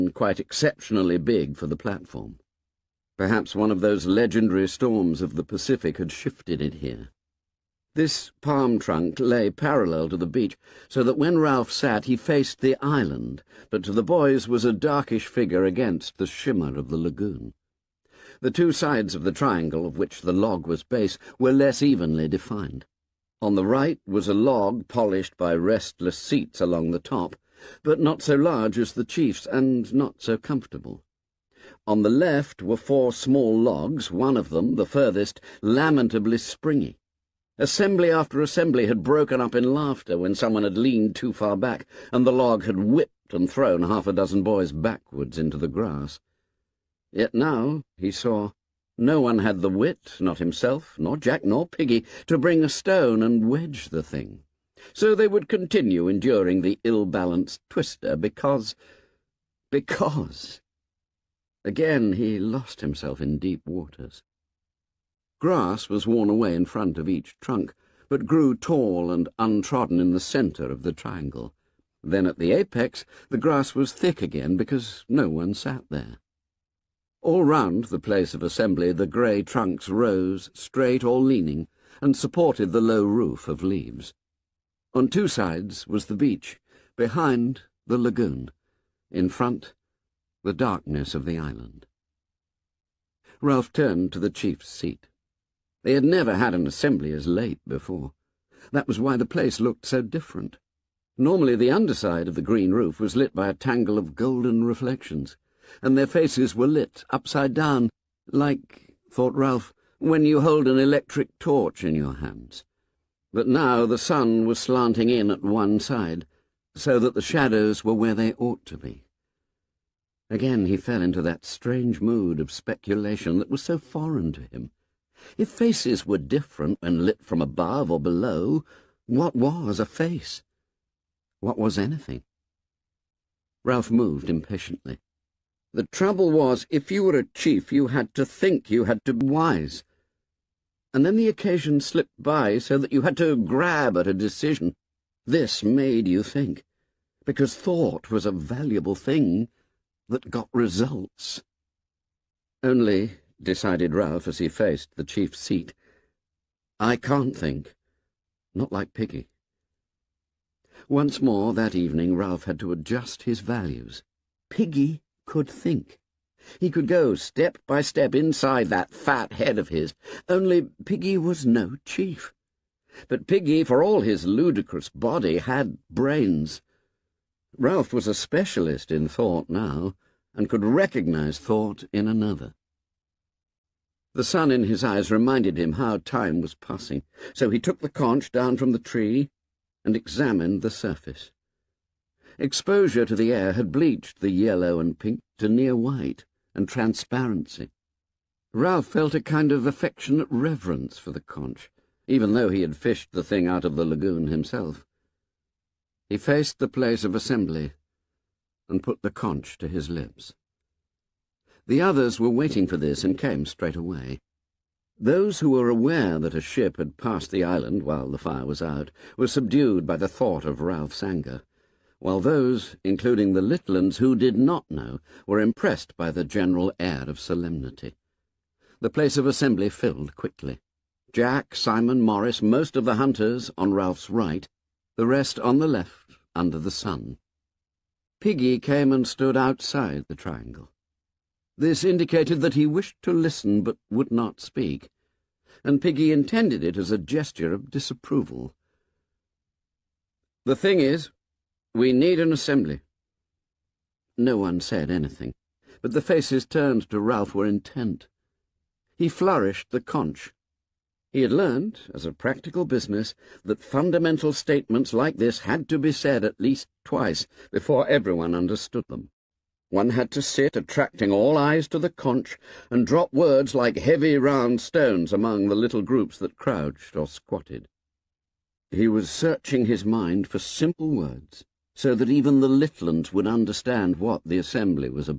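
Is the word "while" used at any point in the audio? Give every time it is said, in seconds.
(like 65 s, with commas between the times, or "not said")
217 s, 221 s.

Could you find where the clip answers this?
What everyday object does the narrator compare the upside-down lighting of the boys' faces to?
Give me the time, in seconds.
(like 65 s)
110 s.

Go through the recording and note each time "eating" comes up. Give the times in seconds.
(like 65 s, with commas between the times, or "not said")
not said.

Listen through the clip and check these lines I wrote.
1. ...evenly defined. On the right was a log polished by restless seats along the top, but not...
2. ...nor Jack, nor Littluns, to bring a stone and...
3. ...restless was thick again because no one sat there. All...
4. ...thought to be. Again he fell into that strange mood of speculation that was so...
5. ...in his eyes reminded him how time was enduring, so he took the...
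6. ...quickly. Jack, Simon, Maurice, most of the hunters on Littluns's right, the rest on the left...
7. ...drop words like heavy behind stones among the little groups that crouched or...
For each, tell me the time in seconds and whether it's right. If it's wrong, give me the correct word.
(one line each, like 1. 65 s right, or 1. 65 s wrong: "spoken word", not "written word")
1. 21 s right
2. 50 s wrong: "Piggy", not "Littluns"
3. 73 s wrong: "grass", not "restless"
4. 118 s wrong: "ought", not "thought"
5. 184 s wrong: "passing", not "enduring"
6. 230 s wrong: "Ralph", not "Littluns"
7. 272 s wrong: "round", not "behind".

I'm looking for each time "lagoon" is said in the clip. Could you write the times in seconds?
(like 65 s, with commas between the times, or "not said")
16 s, 87 s, 203 s.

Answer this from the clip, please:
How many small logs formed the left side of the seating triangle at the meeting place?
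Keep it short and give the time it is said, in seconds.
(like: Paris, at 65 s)
4, at 32 s.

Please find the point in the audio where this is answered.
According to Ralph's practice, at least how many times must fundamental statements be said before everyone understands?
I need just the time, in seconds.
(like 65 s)
266 s.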